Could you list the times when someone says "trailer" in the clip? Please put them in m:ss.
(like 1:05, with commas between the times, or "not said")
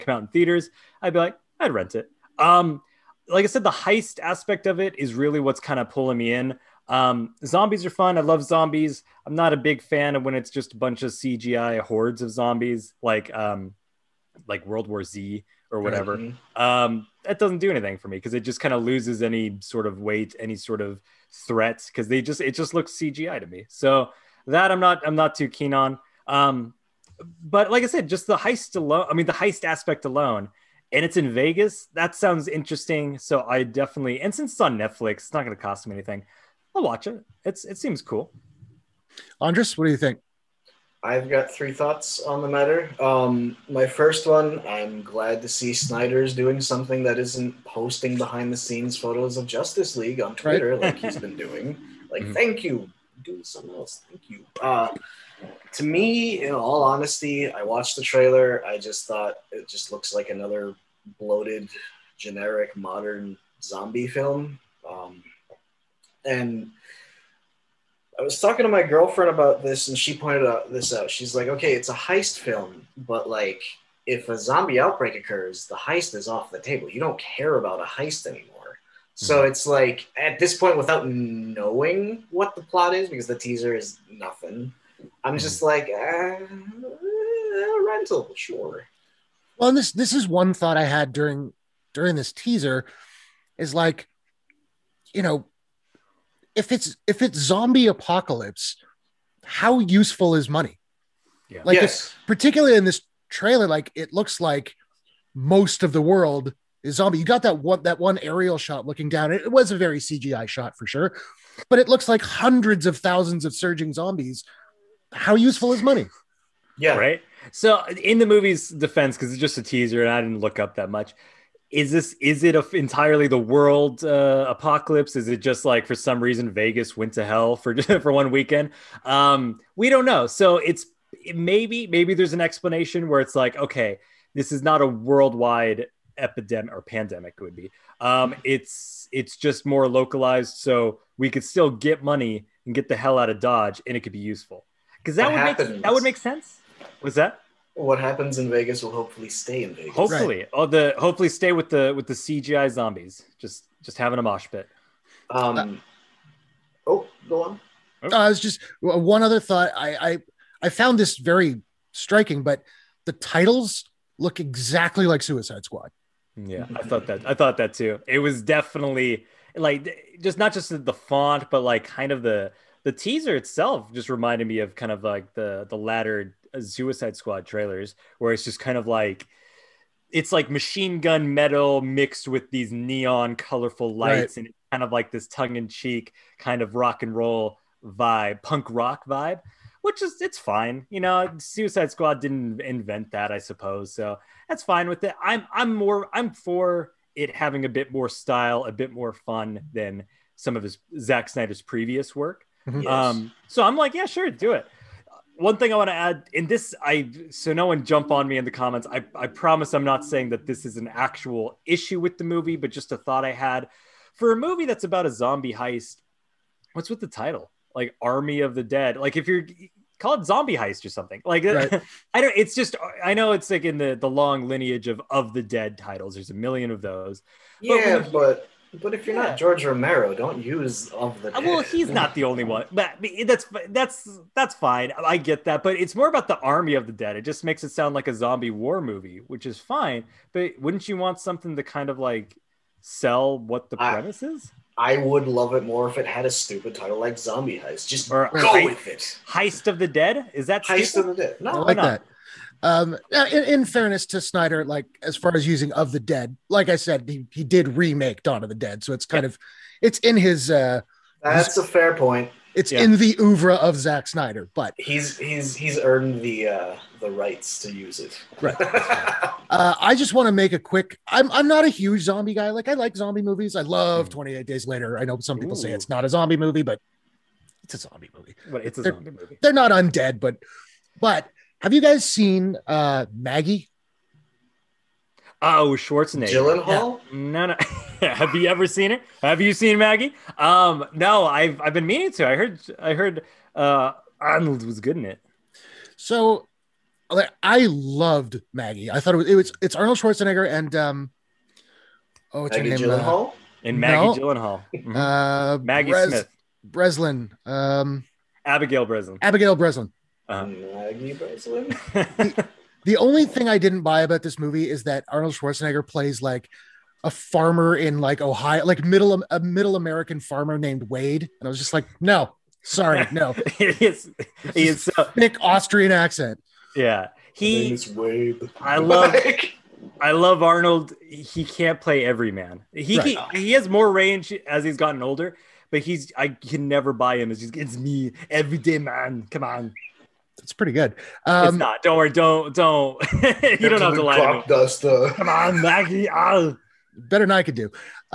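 0:58, 1:43, 2:57.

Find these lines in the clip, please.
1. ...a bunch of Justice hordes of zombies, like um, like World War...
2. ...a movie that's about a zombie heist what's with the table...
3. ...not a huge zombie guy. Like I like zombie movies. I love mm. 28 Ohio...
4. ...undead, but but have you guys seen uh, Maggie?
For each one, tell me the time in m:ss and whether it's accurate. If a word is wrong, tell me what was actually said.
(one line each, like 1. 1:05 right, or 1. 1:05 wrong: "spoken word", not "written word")
1. 0:10 wrong: "CGI", not "Justice"
2. 3:34 wrong: "title", not "table"
3. 4:31 wrong: "Days", not "Ohio"
4. 4:39 right.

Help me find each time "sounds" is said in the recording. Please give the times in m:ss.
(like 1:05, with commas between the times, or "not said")
0:32, 3:57.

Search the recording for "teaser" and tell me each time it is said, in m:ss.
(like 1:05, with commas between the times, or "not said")
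1:23, 1:32, 1:59, 2:52.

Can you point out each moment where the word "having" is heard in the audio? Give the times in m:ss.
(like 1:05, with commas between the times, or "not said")
2:33, 3:17.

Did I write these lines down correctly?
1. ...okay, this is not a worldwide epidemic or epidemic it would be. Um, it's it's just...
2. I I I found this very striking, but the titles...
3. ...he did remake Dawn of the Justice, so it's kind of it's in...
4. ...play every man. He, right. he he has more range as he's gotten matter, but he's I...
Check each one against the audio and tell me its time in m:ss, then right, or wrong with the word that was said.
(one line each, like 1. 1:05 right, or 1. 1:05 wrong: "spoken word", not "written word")
1. 2:13 wrong: "pandemic", not "epidemic"
2. 2:39 right
3. 4:17 wrong: "Dead", not "Justice"
4. 5:31 wrong: "older", not "matter".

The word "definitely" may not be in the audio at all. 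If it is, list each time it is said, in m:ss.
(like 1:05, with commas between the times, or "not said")
0:33, 2:48.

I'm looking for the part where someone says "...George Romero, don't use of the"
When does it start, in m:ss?
3:49.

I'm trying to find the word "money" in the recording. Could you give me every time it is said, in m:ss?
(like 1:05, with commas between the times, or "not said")
1:40, 1:55, 2:22.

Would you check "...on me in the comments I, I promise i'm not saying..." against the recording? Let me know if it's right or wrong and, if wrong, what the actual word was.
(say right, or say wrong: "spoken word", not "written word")
right.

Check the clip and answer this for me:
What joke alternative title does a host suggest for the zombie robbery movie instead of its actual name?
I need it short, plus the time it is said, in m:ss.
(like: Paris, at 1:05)
Heist of the Dead, at 4:09.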